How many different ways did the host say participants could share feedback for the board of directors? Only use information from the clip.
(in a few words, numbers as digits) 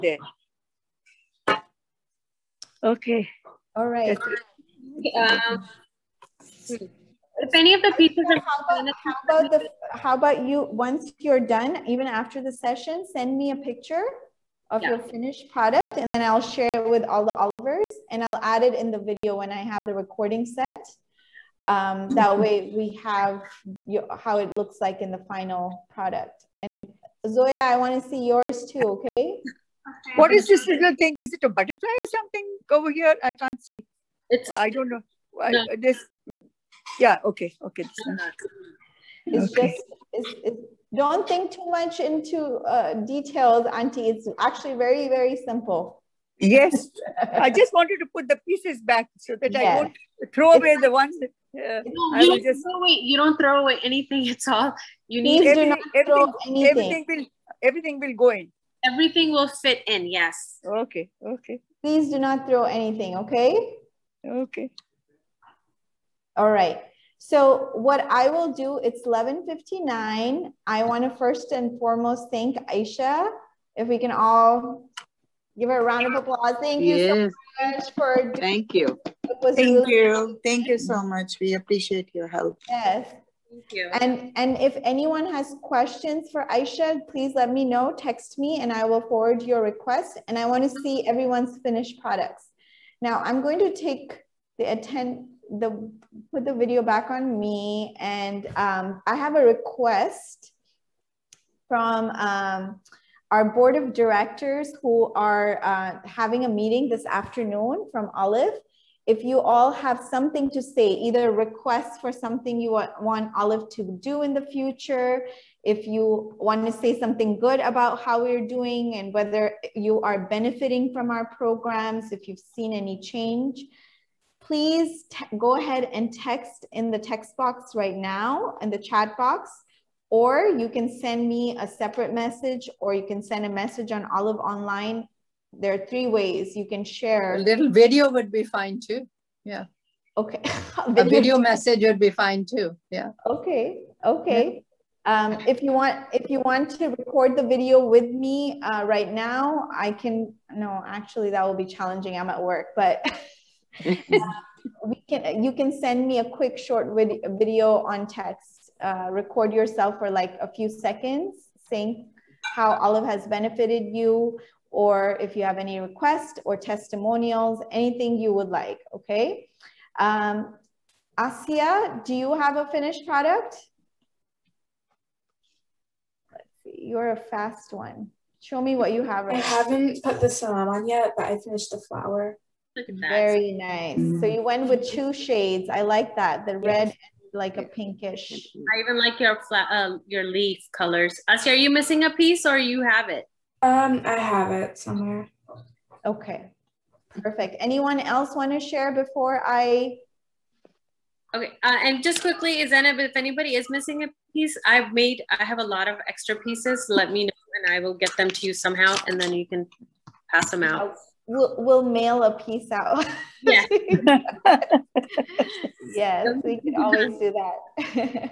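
3.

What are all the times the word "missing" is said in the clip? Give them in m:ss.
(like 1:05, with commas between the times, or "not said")
3:11, 3:23.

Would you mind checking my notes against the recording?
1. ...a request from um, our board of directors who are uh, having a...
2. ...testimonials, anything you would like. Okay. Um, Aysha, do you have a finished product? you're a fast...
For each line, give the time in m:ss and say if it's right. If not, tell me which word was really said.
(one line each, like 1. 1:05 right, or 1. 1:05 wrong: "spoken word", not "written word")
1. 1:39 right
2. 2:46 wrong: "Asia", not "Aysha".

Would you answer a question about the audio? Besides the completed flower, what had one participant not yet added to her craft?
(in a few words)
The salam.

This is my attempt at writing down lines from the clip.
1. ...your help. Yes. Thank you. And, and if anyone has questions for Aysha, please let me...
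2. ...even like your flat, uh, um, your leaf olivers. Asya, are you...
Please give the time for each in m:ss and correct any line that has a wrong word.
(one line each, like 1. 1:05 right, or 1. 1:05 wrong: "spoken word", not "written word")
1. 1:22 right
2. 3:08 wrong: "colors", not "olivers".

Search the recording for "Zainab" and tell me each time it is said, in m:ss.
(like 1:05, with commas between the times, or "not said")
3:22.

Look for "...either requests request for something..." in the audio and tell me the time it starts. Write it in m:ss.
1:50.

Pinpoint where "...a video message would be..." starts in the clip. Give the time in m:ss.
2:21.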